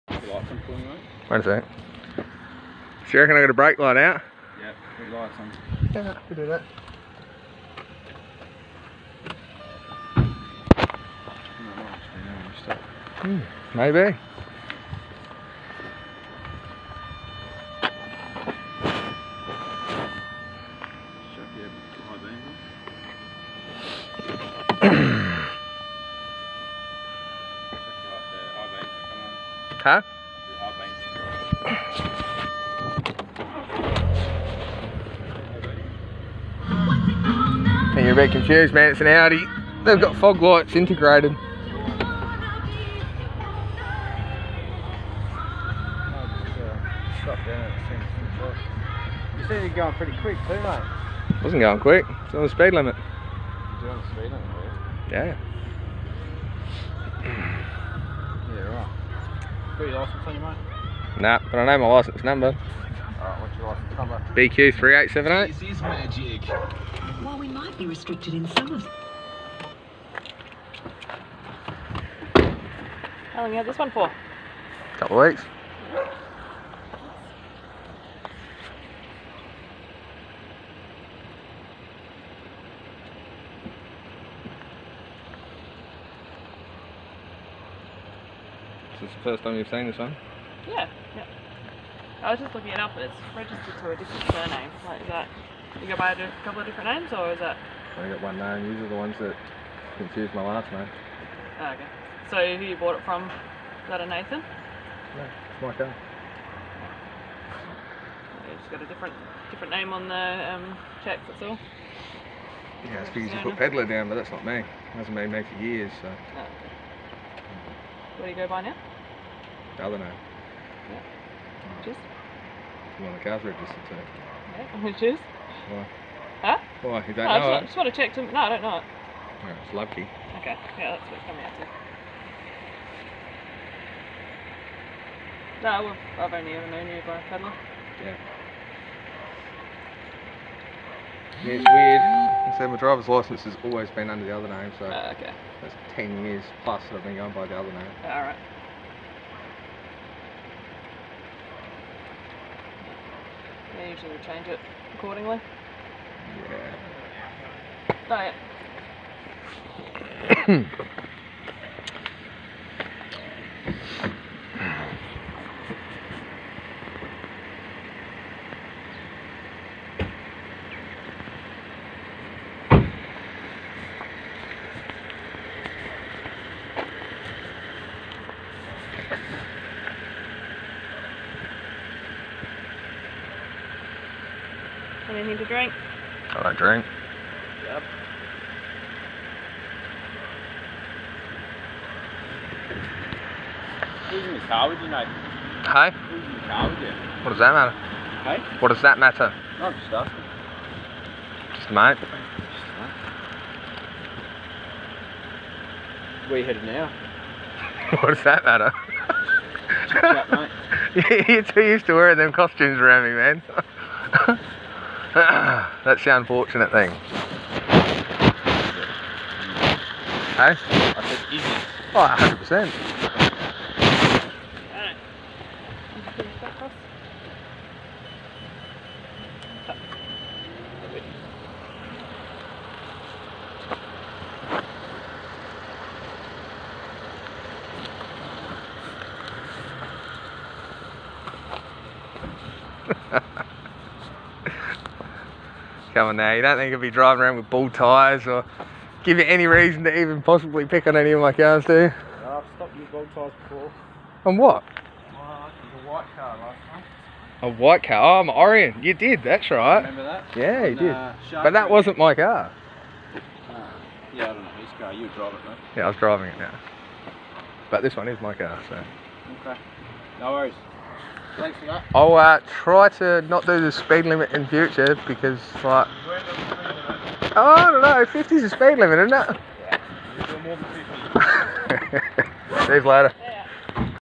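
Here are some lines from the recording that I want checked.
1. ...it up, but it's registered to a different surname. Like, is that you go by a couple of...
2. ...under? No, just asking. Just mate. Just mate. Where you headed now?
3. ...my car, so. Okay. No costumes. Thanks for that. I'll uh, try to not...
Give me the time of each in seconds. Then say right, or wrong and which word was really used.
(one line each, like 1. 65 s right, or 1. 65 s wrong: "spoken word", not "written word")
1. 92 s right
2. 198 s wrong: "matter", not "under"
3. 268 s wrong: "worries", not "costumes".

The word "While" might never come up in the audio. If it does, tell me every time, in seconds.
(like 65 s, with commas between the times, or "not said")
67 s.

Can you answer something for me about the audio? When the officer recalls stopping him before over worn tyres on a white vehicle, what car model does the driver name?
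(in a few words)
Orion.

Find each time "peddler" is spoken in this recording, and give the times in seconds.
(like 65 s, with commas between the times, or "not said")
113 s, 137 s.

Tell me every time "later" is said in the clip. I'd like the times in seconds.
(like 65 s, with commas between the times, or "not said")
282 s.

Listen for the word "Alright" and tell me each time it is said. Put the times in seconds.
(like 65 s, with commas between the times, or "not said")
62 s, 148 s.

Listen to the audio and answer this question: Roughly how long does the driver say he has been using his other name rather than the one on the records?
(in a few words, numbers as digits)
10 years plus.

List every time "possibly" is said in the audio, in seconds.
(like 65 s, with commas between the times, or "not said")
250 s.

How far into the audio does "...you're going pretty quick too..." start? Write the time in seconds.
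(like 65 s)
49 s.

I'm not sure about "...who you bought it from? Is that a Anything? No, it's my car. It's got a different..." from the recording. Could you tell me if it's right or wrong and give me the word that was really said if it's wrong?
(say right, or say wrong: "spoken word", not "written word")
wrong: "Nathan", not "Anything".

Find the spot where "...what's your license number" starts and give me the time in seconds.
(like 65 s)
63 s.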